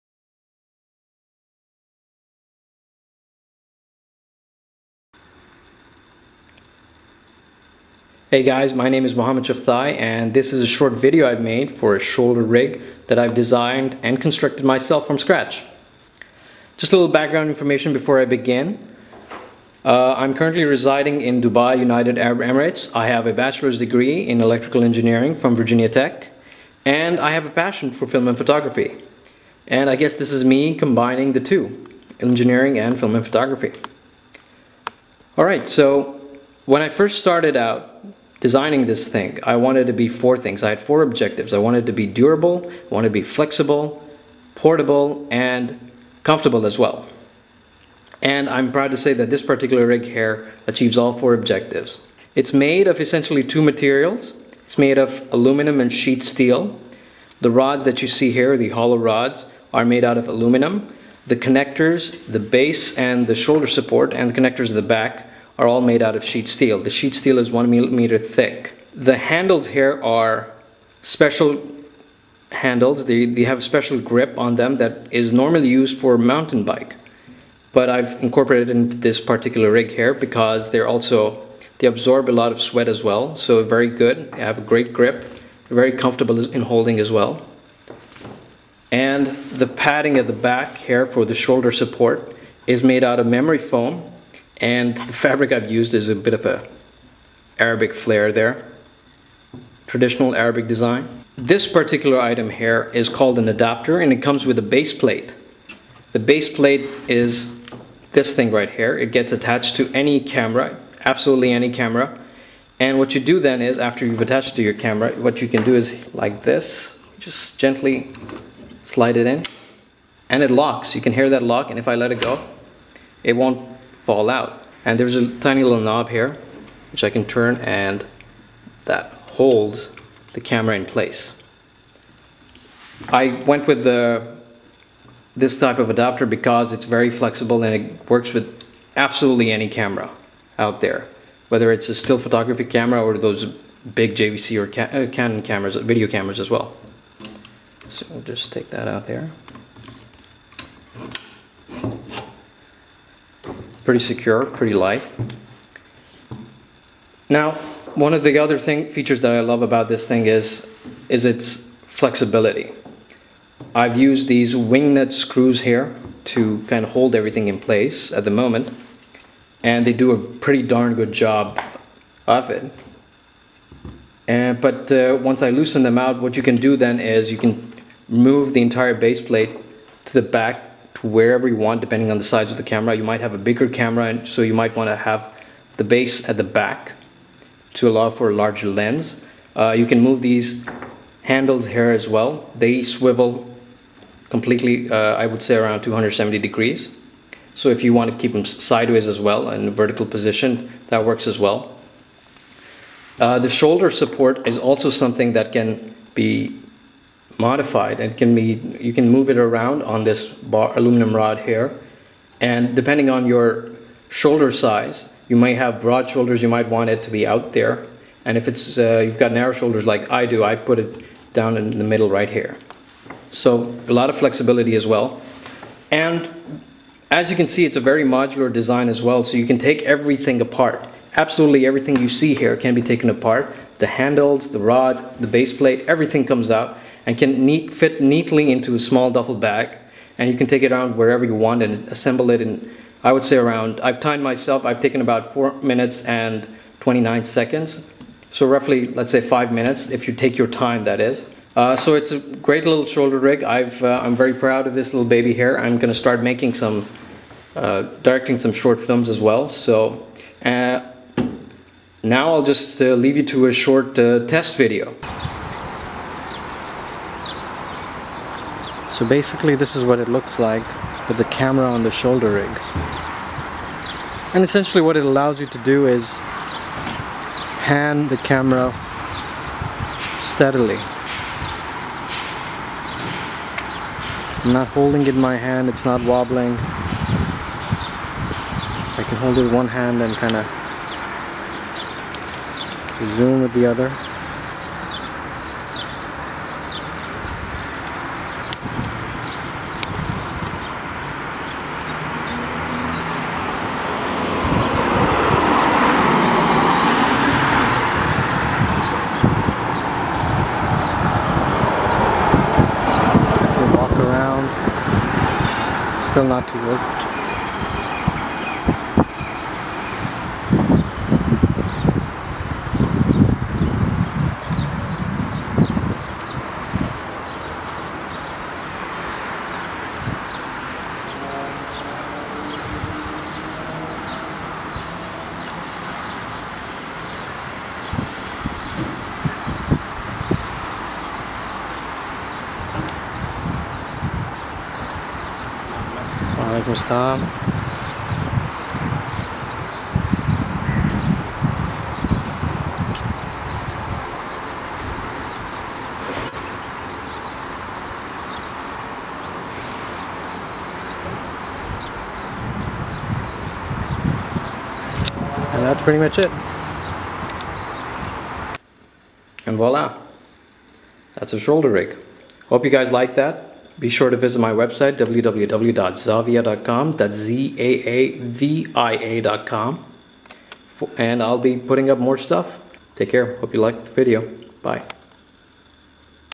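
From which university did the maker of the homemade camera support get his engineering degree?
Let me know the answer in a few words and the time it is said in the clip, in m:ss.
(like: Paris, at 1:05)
Virginia Tech, at 0:25.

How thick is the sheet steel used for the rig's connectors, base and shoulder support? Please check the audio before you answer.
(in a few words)
1 millimeter.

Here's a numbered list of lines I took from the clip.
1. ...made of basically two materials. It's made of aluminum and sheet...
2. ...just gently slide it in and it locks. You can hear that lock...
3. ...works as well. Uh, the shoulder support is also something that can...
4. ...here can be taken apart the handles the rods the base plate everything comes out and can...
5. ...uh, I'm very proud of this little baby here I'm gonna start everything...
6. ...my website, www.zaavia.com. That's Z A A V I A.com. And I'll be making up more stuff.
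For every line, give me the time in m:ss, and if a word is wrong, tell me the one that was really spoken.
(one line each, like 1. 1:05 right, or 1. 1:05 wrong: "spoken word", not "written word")
1. 0:52 wrong: "essentially", not "basically"
2. 1:57 right
3. 3:21 right
4. 3:52 right
5. 4:13 wrong: "making", not "everything"
6. 6:14 wrong: "putting", not "making".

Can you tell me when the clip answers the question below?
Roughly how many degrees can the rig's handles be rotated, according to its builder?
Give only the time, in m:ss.
3:15.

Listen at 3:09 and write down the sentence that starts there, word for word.
Uh, you can move these handles here as well.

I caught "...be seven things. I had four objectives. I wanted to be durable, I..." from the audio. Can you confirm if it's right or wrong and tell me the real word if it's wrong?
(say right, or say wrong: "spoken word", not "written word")
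wrong: "four", not "seven".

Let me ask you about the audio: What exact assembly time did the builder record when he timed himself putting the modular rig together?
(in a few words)
4 minutes 29 seconds.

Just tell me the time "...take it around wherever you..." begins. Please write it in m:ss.
4:00.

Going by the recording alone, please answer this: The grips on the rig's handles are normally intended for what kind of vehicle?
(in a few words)
mountain bike.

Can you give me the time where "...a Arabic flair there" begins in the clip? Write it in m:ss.
1:36.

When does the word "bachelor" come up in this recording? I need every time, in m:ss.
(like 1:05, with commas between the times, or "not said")
0:23.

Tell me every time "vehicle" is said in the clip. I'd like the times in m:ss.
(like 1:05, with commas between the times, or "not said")
not said.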